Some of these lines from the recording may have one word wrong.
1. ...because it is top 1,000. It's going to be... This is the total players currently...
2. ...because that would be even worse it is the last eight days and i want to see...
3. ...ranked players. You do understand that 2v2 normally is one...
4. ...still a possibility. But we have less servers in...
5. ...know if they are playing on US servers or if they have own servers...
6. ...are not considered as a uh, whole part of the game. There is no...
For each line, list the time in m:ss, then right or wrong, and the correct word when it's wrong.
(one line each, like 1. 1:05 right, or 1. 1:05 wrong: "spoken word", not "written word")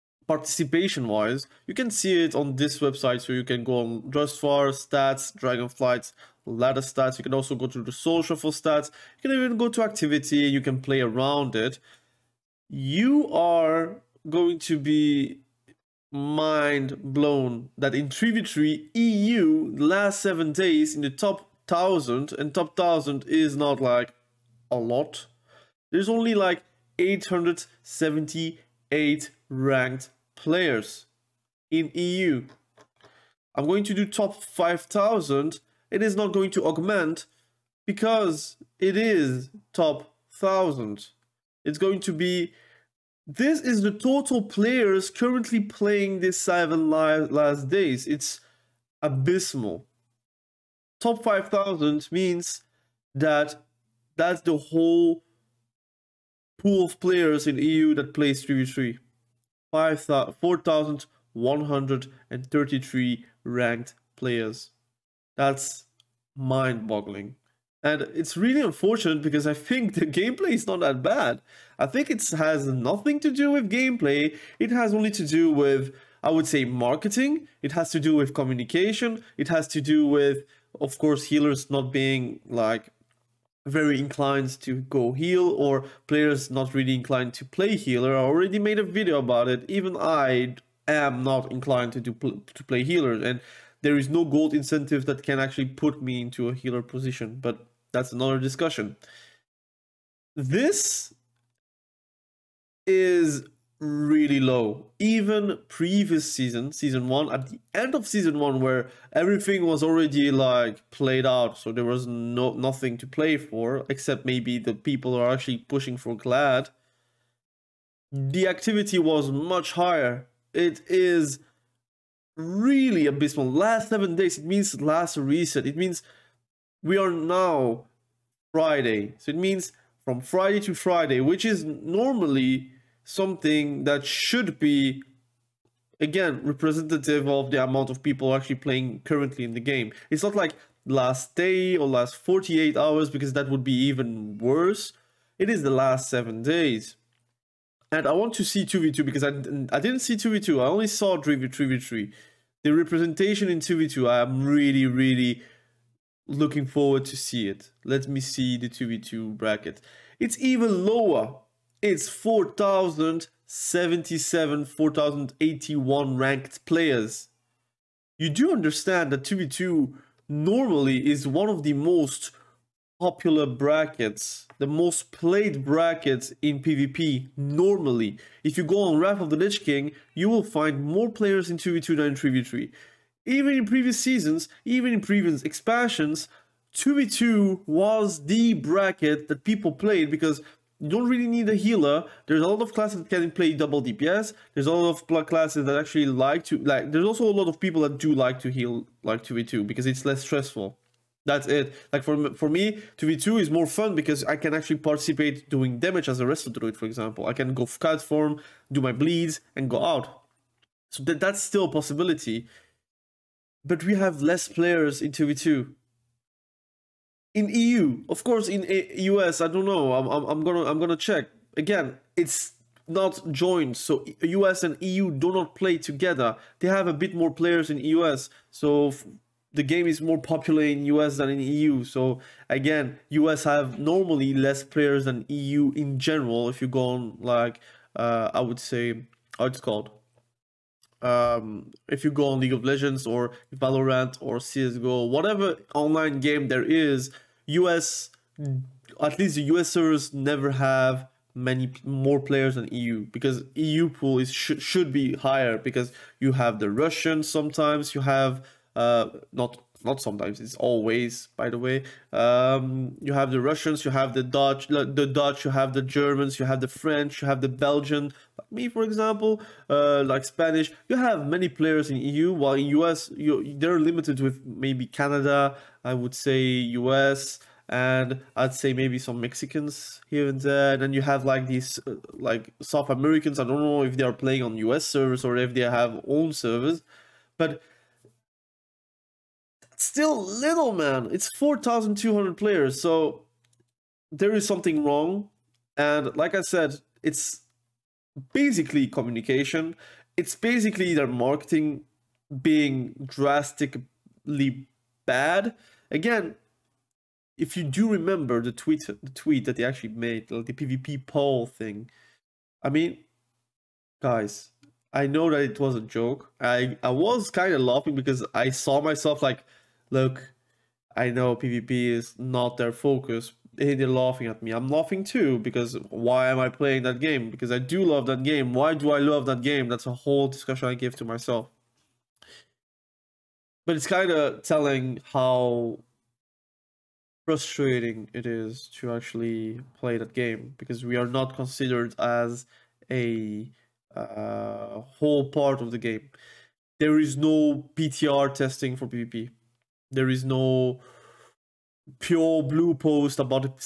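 1. 0:37 right
2. 2:23 wrong: "seven", not "eight"
3. 2:46 right
4. 3:31 wrong: "players", not "servers"
5. 4:43 right
6. 5:40 right.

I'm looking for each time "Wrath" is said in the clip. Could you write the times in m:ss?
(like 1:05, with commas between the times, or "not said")
2:58.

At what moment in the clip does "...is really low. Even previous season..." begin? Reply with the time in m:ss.
1:42.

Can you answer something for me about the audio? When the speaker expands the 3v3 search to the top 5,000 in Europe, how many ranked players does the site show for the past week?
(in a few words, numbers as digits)
4,133.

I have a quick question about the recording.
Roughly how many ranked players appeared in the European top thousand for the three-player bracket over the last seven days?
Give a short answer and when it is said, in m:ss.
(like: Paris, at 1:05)
878, at 0:26.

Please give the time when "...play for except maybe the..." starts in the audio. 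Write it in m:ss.
1:53.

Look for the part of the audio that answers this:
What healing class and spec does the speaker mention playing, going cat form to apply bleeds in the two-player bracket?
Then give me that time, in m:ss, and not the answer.
3:26.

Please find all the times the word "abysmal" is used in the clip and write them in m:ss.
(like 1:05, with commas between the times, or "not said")
0:49, 2:03.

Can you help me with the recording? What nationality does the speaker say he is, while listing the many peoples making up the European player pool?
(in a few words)
Belgian.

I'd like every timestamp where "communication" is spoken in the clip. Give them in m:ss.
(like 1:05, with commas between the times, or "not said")
1:18, 4:58.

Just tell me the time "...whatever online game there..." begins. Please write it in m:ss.
4:05.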